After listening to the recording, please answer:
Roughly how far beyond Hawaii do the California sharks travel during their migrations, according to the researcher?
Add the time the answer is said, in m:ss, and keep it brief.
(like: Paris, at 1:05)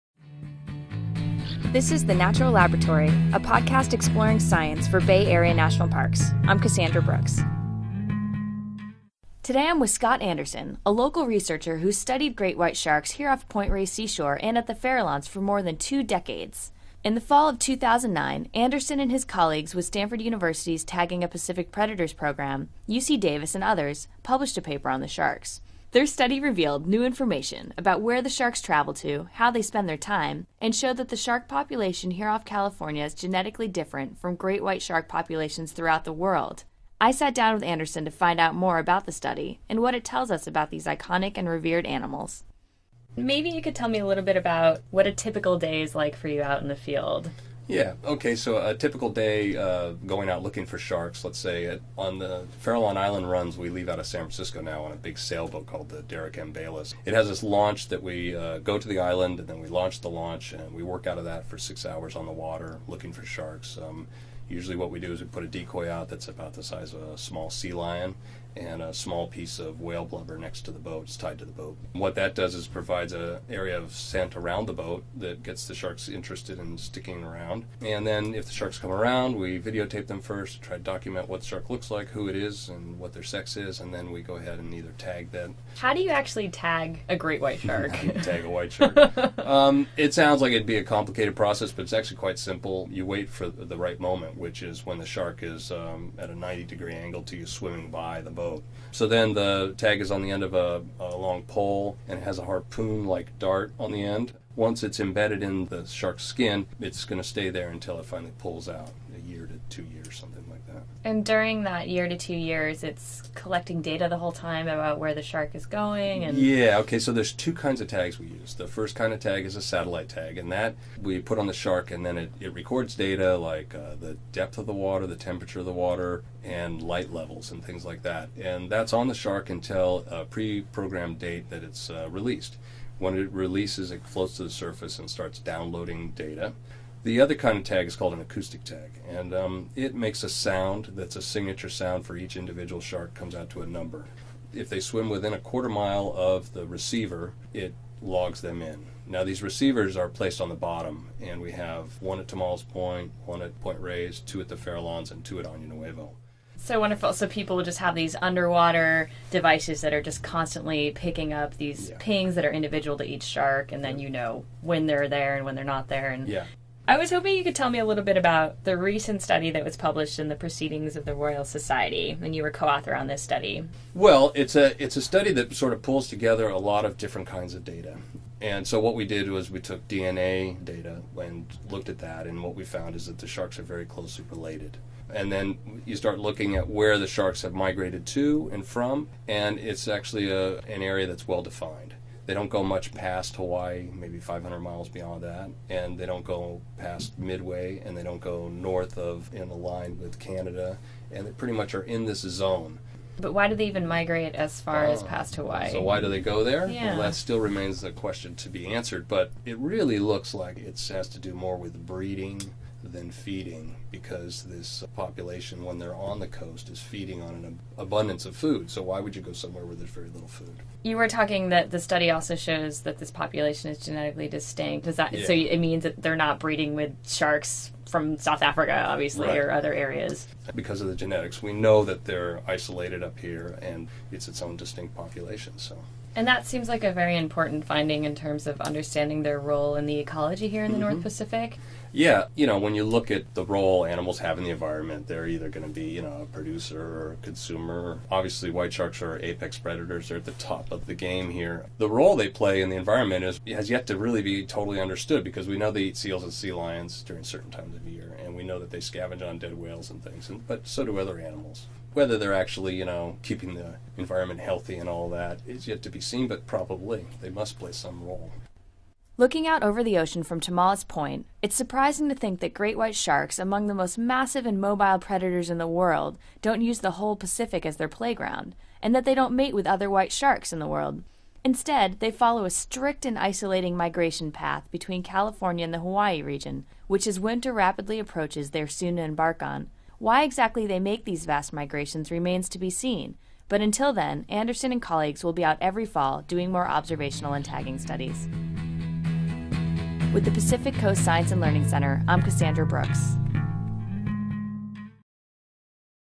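500 miles, at 3:14.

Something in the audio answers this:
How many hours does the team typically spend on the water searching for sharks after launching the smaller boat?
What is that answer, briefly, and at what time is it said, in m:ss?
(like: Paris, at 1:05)
6, at 1:01.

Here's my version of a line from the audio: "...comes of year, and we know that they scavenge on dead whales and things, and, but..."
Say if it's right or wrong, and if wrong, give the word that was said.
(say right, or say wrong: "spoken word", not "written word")
wrong: "times", not "comes".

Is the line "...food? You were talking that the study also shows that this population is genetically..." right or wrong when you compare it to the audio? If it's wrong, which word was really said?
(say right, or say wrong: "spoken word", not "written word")
right.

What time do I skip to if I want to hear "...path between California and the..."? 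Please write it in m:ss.
4:44.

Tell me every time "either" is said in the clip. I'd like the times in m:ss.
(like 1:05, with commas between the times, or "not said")
1:24, 4:05.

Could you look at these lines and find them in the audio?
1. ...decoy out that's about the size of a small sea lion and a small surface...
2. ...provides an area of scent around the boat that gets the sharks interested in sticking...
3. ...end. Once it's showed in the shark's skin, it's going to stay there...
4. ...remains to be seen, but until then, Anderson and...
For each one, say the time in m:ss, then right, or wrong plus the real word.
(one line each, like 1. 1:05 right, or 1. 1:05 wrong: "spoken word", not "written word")
1. 1:05 wrong: "piece", not "surface"
2. 1:12 right
3. 1:44 wrong: "embedded", not "showed"
4. 4:52 right.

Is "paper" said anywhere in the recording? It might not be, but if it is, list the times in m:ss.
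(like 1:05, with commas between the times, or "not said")
0:24.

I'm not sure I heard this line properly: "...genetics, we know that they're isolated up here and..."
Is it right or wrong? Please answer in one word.
right.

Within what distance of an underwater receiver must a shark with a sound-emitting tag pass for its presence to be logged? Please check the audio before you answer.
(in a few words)
a quarter mile.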